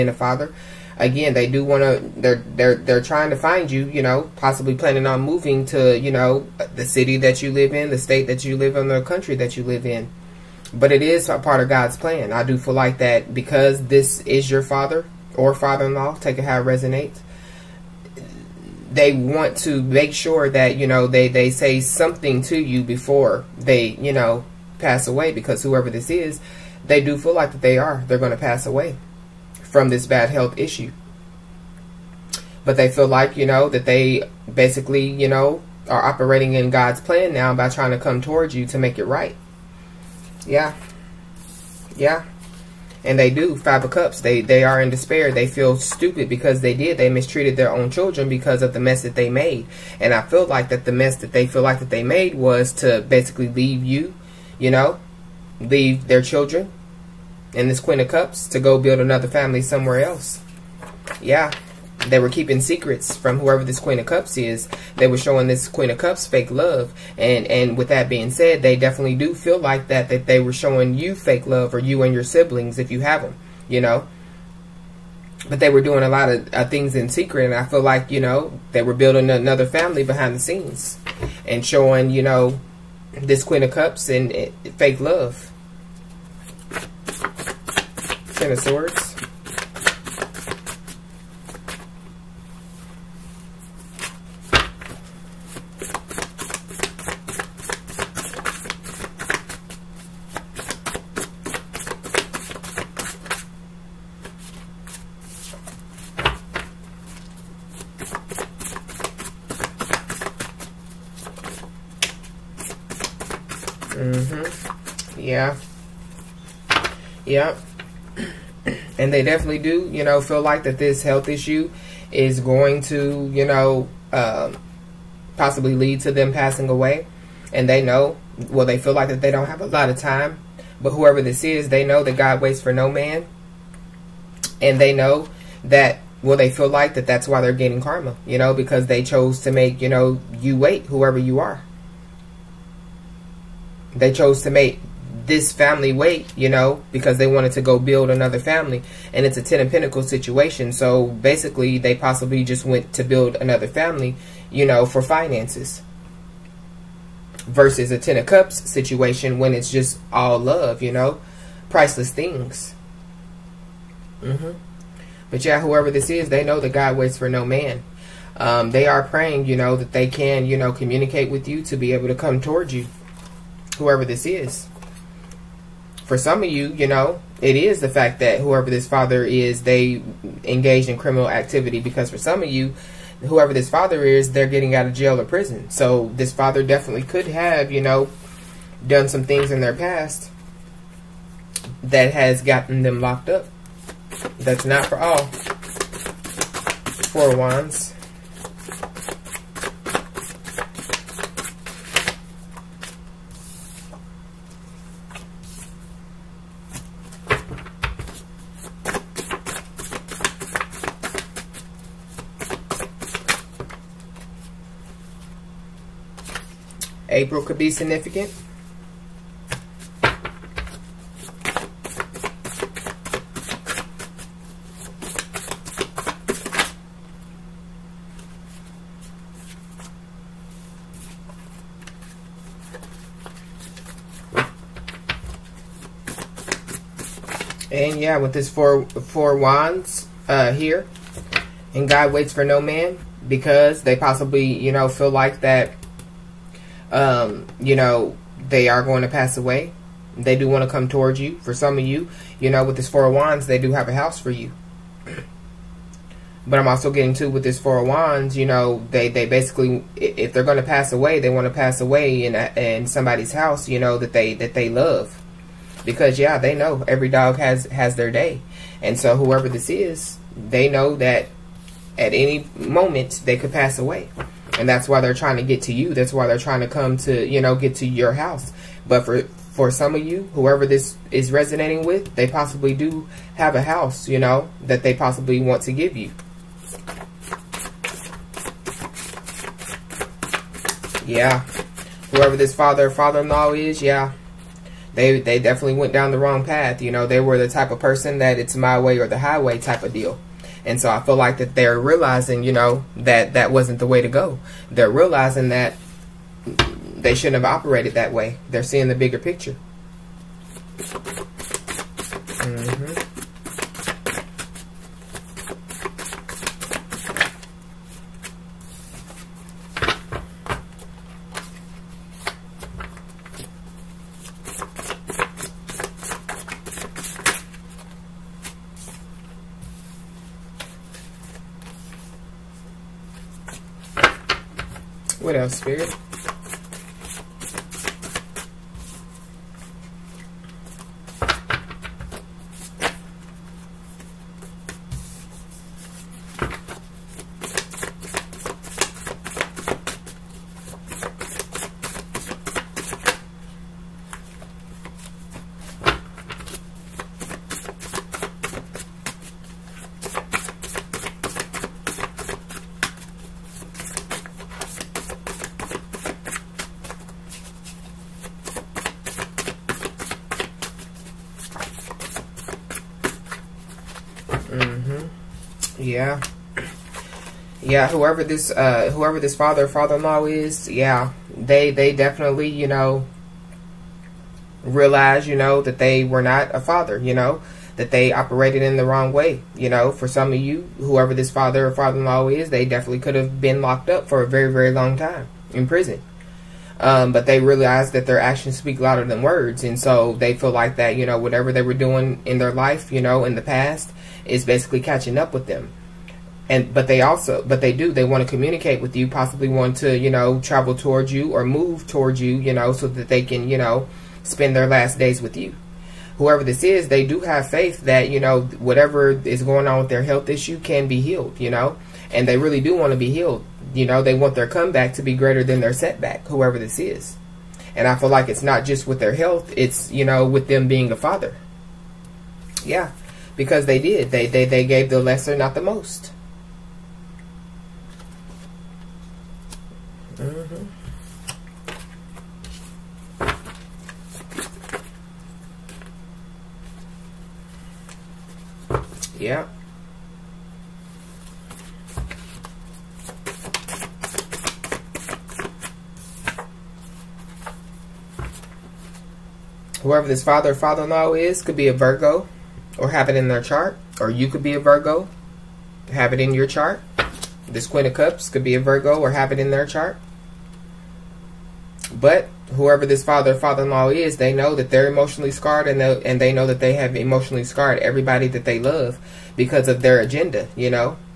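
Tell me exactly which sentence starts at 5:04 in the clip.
They're realizing that they shouldn't have operated that way.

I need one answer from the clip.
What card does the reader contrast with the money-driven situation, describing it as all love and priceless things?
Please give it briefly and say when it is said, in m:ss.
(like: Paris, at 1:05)
Ten of Cups, at 2:37.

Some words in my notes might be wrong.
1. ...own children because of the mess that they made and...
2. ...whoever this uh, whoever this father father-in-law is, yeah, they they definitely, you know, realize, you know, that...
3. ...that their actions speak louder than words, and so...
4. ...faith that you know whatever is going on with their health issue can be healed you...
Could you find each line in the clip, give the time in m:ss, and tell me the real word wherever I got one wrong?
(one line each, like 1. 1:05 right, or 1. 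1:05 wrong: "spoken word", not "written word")
1. 0:47 right
2. 6:17 right
3. 6:37 right
4. 6:57 right.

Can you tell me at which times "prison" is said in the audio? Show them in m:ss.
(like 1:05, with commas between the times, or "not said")
3:05, 6:35.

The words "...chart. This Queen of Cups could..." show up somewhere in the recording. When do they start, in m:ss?
7:46.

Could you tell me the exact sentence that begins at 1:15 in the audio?
But they were doing a lot of uh, things in secret.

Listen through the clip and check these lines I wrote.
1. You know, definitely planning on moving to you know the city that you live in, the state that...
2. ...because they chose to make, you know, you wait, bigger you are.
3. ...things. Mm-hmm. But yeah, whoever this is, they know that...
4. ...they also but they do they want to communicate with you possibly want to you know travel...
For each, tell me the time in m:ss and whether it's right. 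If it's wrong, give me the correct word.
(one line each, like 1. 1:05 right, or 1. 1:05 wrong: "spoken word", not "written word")
1. 0:03 wrong: "possibly", not "definitely"
2. 2:18 wrong: "whoever", not "bigger"
3. 2:42 right
4. 6:46 right.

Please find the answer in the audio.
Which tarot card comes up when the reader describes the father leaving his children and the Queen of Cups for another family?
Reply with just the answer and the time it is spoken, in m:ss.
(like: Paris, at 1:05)
Five of Cups, at 0:43.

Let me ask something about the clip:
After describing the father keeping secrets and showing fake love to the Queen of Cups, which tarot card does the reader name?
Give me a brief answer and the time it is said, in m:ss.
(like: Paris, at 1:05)
Ten of Swords, at 1:28.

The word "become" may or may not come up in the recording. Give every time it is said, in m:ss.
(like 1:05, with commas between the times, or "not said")
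not said.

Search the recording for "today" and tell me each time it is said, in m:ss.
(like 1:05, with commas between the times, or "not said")
not said.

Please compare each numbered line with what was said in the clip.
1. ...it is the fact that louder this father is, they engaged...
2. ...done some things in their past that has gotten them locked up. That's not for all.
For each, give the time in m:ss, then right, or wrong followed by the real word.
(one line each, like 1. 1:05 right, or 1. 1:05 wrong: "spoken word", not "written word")
1. 2:57 wrong: "whoever", not "louder"
2. 3:08 right.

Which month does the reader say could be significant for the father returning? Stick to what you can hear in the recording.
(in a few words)
April.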